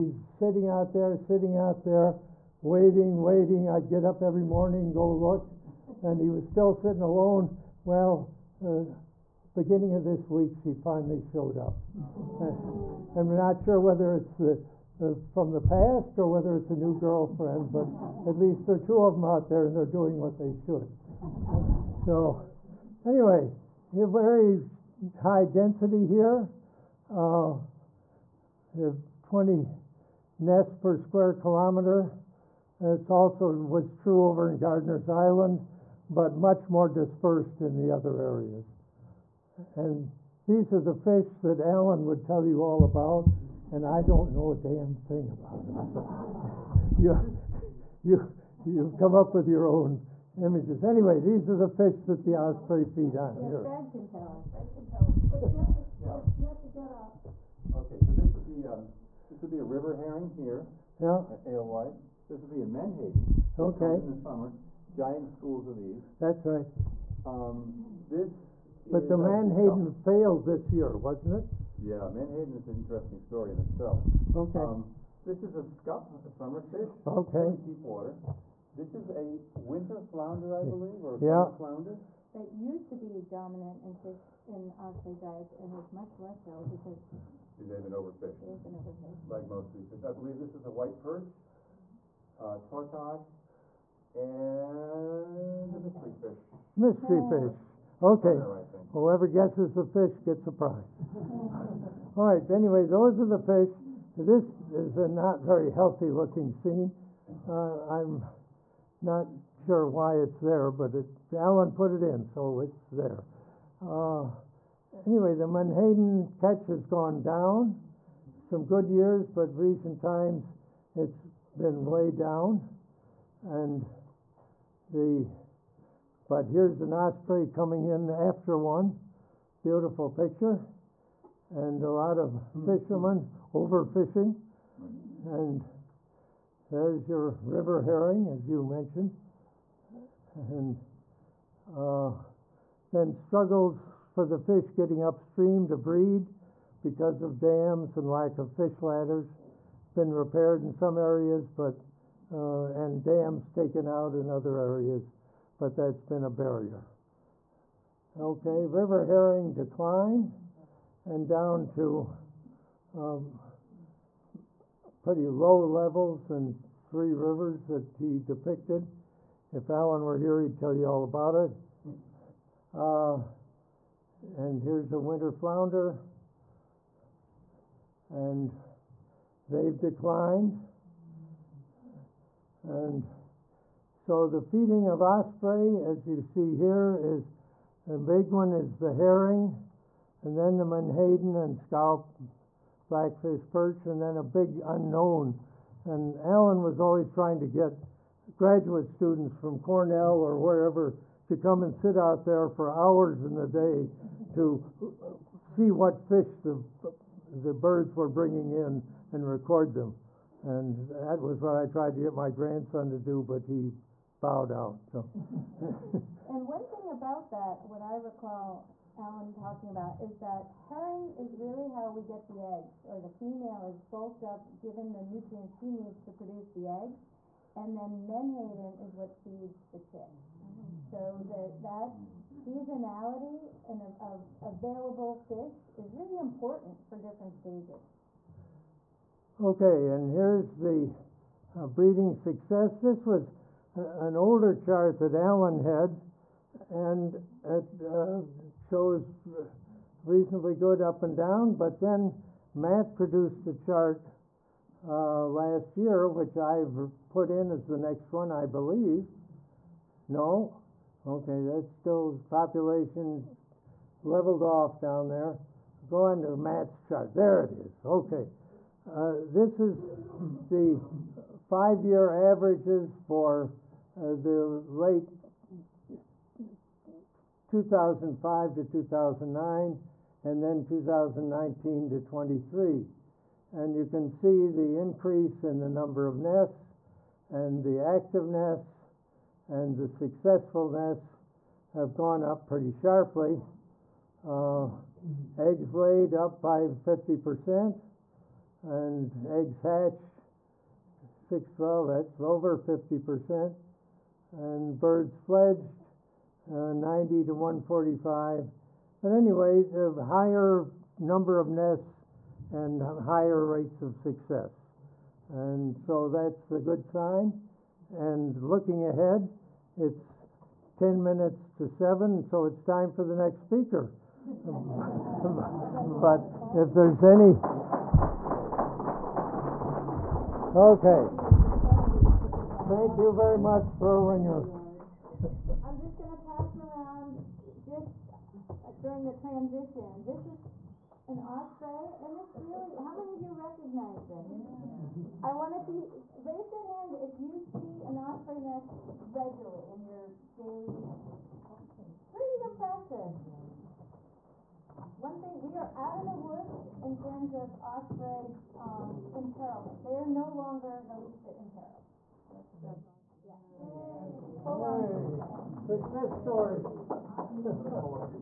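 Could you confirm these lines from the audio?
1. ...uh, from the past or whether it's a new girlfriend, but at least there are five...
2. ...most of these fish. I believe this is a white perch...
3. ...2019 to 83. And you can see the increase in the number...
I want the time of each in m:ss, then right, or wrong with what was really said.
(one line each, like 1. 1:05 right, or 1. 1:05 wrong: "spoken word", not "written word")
1. 0:15 wrong: "two", not "five"
2. 1:29 right
3. 4:40 wrong: "23", not "83".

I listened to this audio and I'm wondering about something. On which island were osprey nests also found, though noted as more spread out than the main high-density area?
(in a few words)
Gardiner's Island.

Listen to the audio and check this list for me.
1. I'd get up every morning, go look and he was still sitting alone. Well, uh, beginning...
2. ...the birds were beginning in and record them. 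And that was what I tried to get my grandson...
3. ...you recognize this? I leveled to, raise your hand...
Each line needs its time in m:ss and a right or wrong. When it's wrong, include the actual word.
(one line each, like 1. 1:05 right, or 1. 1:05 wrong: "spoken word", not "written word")
1. 0:03 right
2. 3:27 wrong: "bringing", not "beginning"
3. 5:43 wrong: "wanted", not "leveled".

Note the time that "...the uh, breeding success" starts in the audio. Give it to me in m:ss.
4:00.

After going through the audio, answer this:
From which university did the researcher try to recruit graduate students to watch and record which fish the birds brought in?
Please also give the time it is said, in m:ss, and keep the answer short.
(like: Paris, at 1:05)
Cornell, at 3:19.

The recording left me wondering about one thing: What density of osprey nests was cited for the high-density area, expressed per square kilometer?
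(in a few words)
20.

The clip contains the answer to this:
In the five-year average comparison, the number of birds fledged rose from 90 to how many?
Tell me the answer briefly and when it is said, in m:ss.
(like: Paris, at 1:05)
145, at 5:07.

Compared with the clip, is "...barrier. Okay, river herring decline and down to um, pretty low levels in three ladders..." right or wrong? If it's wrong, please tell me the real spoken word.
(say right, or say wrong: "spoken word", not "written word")
wrong: "rivers", not "ladders".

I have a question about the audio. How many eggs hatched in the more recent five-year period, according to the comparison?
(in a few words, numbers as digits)
612.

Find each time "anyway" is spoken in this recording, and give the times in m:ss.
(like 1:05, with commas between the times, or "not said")
0:23, 0:50, 1:42, 1:55, 5:09.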